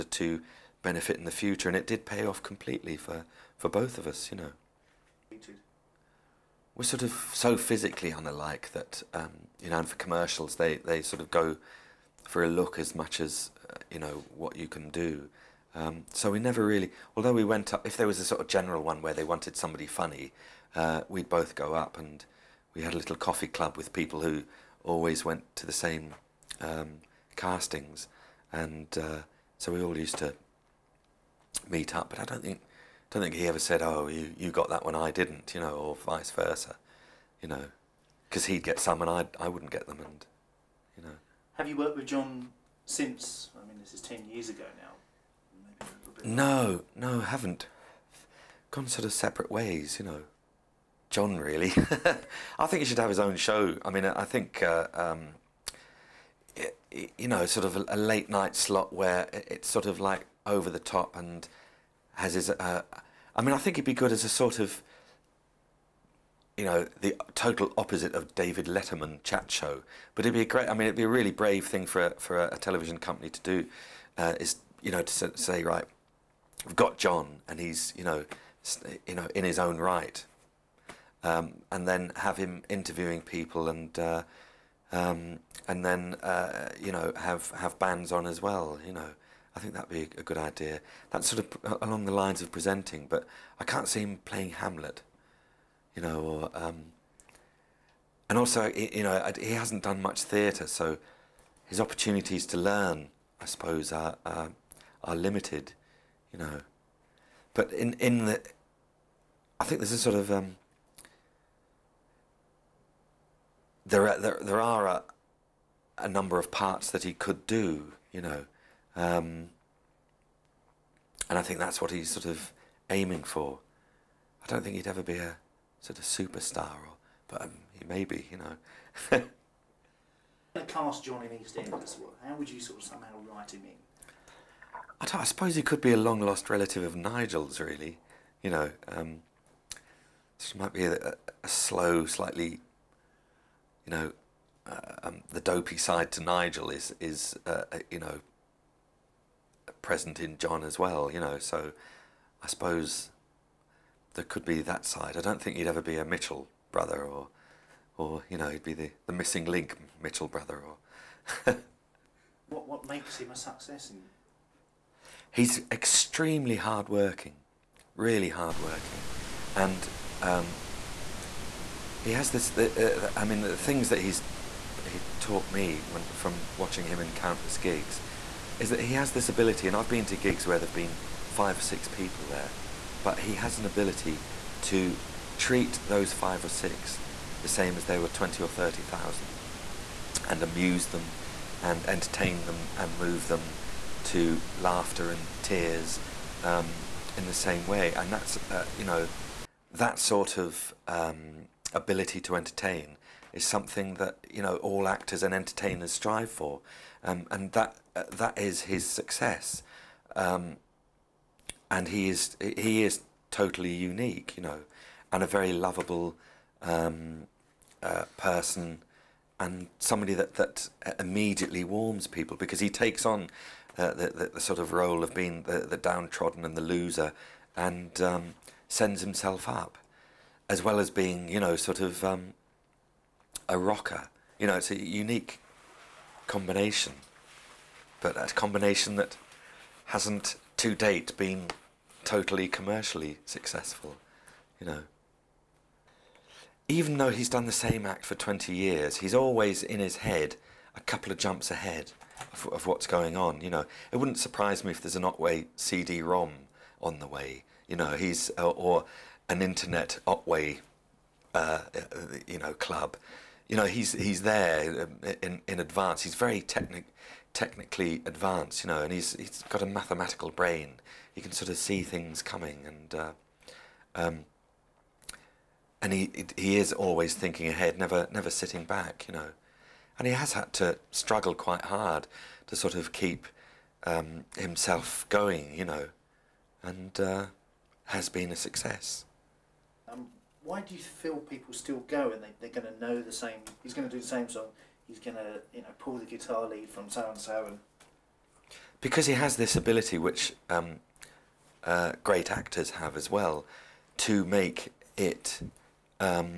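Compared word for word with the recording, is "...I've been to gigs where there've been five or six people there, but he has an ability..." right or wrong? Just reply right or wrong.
right.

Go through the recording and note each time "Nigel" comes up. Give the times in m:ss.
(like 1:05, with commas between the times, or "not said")
2:16, 2:26.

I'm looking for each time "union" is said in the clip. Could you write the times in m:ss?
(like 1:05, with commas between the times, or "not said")
not said.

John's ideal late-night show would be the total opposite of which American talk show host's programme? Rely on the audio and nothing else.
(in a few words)
David Letterman.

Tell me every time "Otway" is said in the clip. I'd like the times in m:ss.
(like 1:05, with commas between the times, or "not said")
4:15, 4:20.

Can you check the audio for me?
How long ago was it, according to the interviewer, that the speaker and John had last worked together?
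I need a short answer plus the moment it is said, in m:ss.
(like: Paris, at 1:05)
10 years, at 0:44.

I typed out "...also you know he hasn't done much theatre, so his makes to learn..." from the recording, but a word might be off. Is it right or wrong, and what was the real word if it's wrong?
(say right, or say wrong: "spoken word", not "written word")
wrong: "opportunities", not "makes".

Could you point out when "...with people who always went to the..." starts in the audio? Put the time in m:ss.
0:23.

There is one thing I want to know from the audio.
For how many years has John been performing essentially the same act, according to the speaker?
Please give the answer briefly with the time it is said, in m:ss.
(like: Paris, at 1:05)
20, at 4:08.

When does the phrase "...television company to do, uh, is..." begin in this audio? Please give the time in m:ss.
1:12.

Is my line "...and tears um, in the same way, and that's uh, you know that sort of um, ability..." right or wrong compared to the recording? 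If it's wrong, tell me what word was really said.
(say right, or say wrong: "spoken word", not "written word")
right.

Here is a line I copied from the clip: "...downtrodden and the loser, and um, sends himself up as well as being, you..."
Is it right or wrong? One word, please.
right.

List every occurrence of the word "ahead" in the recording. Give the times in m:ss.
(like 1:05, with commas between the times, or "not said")
4:11, 4:37.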